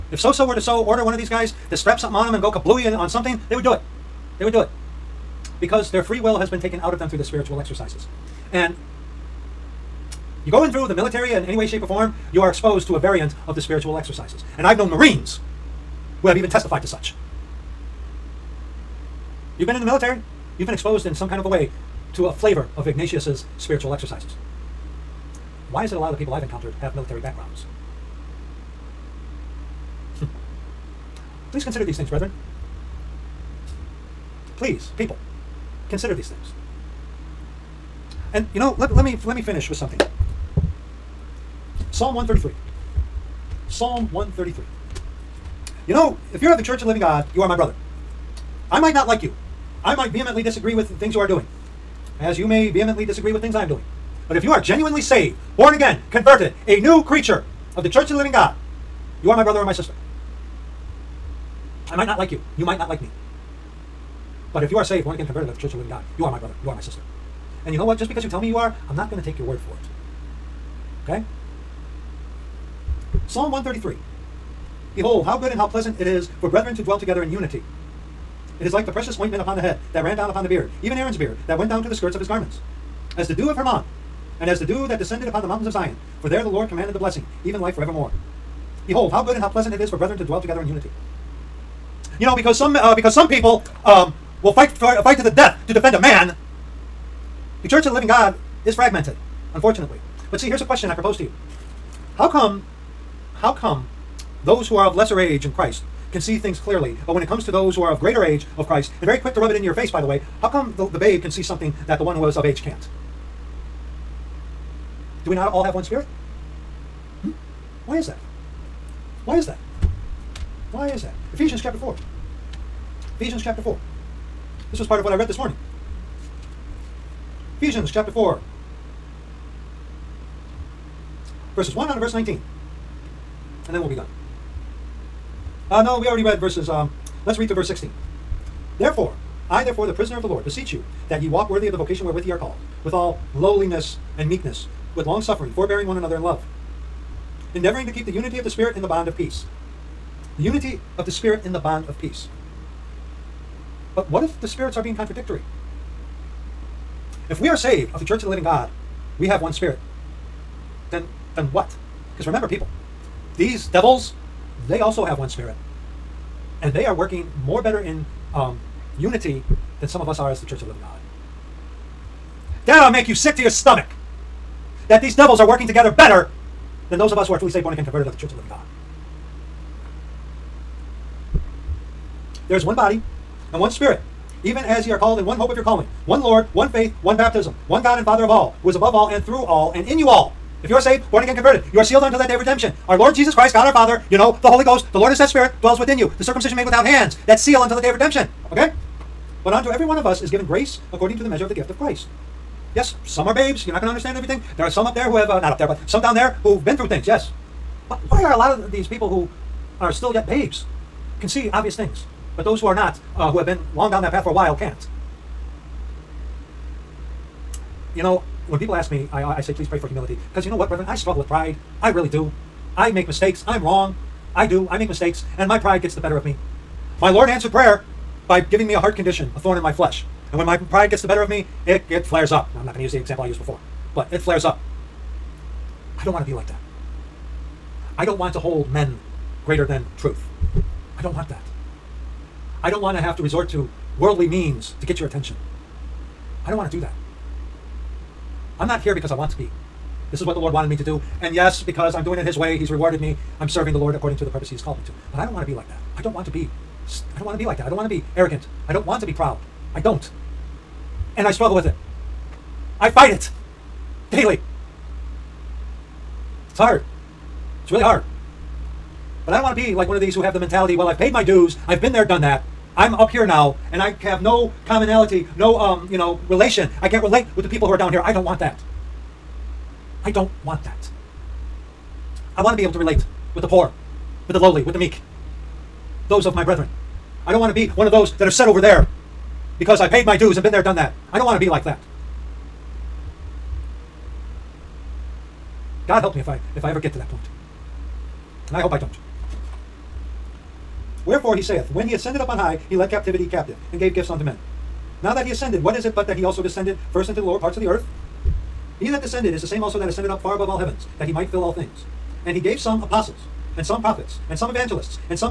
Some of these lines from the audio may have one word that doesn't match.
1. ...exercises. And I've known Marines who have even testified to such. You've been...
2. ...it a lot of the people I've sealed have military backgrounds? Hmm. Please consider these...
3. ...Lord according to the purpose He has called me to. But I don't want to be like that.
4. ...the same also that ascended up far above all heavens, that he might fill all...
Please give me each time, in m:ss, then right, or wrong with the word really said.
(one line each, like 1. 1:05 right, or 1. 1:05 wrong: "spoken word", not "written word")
1. 0:13 right
2. 0:25 wrong: "encountered", not "sealed"
3. 4:13 right
4. 5:09 right.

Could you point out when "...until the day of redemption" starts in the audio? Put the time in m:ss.
3:17.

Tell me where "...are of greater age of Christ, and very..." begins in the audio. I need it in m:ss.
1:47.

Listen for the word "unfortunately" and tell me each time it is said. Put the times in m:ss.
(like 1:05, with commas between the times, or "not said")
1:39.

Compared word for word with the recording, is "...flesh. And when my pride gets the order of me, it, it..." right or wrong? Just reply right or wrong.
wrong.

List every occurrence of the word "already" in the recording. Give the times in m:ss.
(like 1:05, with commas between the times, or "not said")
2:16.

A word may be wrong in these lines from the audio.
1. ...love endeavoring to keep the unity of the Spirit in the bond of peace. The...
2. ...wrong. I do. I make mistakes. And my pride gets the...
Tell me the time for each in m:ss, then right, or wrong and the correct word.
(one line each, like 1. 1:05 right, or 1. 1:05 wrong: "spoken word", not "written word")
1. 2:26 right
2. 3:43 right.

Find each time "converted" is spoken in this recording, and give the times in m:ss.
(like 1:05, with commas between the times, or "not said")
0:56, 1:05, 2:57, 3:11.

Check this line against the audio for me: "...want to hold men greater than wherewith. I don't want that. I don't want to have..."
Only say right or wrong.
wrong.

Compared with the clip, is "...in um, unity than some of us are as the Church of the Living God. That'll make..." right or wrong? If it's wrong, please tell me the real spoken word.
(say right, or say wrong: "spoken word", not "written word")
right.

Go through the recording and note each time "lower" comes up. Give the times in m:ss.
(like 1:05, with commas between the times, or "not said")
5:07.